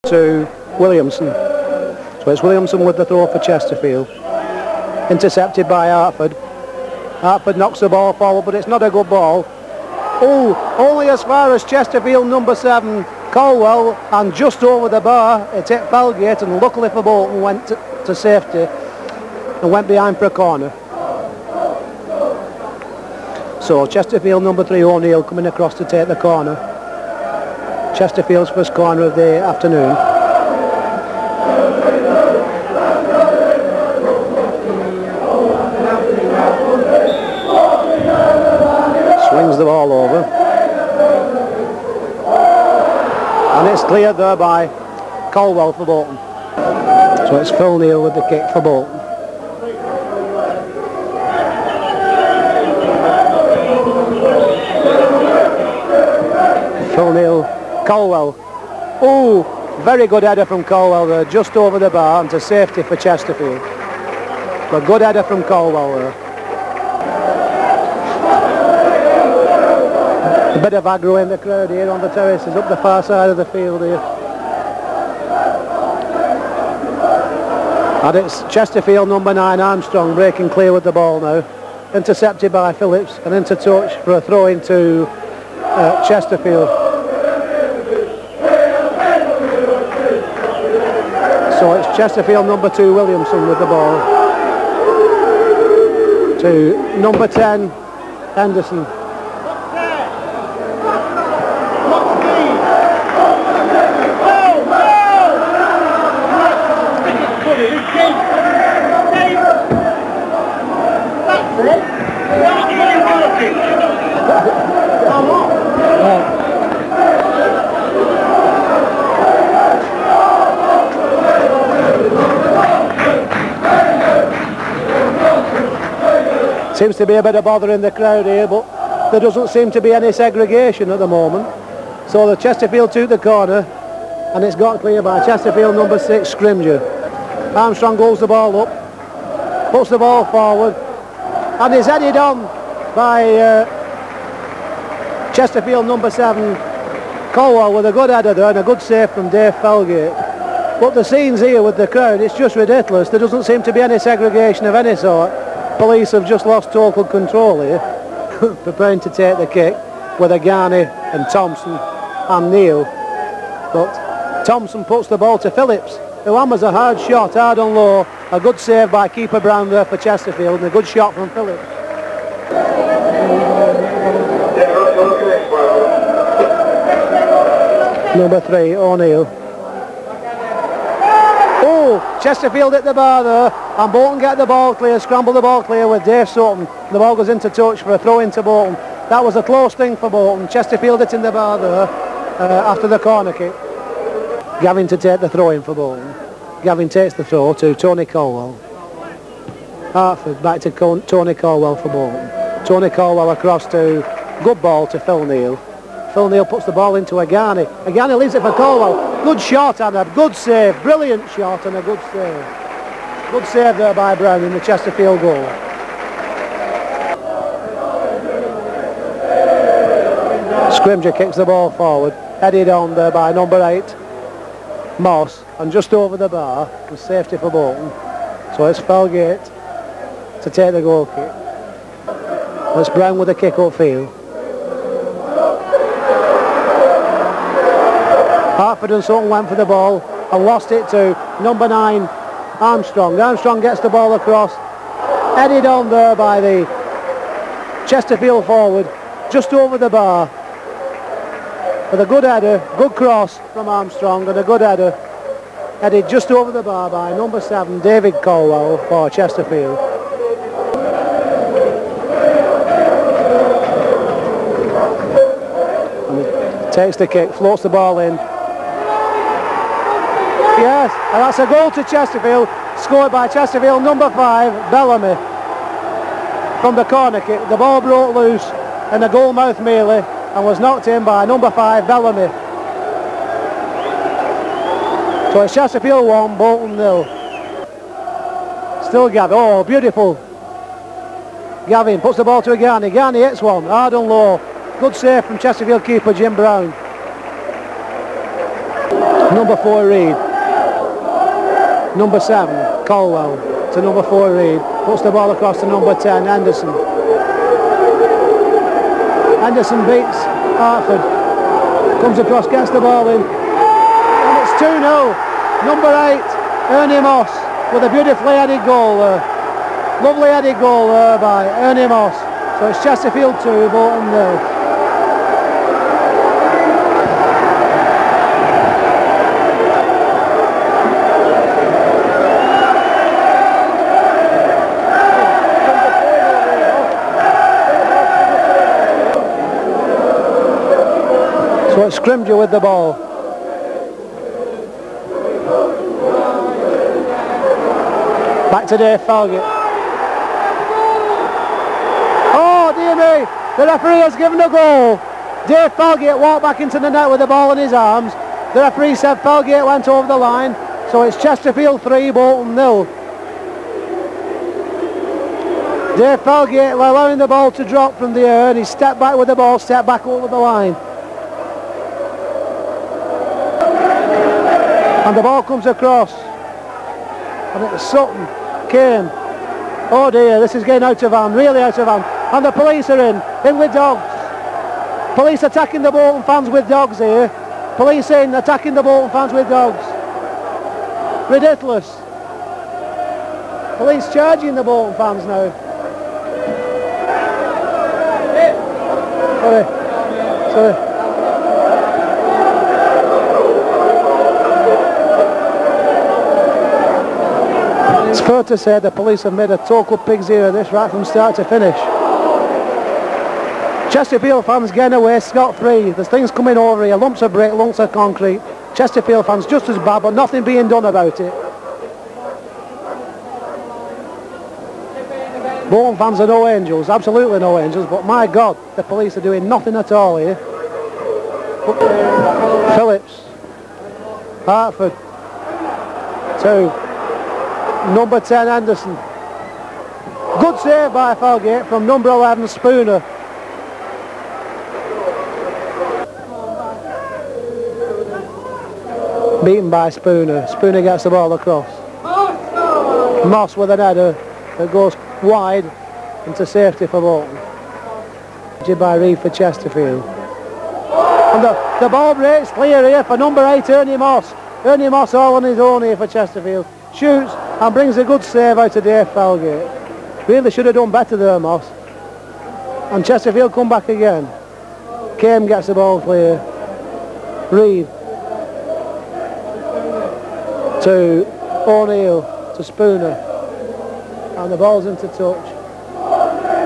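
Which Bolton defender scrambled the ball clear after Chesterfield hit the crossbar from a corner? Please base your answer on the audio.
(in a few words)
Dave Sutton.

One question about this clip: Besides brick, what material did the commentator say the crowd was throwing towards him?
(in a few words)
Concrete.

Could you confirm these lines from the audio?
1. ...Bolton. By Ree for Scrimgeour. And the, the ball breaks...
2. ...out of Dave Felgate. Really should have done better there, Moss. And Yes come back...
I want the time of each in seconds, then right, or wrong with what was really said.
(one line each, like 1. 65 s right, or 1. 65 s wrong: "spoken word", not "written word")
1. 457 s wrong: "Chesterfield", not "Scrimgeour"
2. 468 s wrong: "Chesterfield", not "Yes".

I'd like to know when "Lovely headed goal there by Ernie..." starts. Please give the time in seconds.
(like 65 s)
320 s.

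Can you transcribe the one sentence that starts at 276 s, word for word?
From the corner kick, the ball broke loose in the goalmouth merely and was knocked in by number five, Bellamy.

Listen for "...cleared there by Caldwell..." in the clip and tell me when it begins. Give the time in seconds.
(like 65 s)
43 s.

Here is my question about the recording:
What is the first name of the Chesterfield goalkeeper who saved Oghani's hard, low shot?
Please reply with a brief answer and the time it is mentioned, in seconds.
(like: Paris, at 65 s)
Jim, at 296 s.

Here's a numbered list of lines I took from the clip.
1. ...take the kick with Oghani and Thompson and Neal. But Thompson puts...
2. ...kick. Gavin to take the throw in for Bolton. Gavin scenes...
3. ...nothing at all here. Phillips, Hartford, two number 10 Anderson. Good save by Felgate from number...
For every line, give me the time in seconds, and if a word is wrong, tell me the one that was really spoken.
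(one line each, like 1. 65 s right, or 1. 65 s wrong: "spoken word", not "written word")
1. 159 s right
2. 193 s wrong: "takes", not "scenes"
3. 429 s right.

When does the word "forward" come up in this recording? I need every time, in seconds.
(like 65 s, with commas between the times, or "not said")
8 s, 140 s, 221 s, 248 s.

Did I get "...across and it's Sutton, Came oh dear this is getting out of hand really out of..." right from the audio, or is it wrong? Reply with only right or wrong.
right.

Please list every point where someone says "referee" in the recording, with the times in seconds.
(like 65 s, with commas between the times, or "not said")
353 s, 358 s.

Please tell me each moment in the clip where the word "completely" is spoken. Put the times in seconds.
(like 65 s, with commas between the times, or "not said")
not said.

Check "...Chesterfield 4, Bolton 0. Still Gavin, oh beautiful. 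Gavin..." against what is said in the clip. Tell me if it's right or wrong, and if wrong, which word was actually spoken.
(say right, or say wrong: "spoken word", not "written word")
wrong: "1", not "4".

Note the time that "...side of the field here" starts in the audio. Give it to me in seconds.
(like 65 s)
73 s.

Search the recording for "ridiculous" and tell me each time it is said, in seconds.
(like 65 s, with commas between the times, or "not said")
152 s, 391 s.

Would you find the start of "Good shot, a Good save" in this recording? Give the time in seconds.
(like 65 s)
209 s.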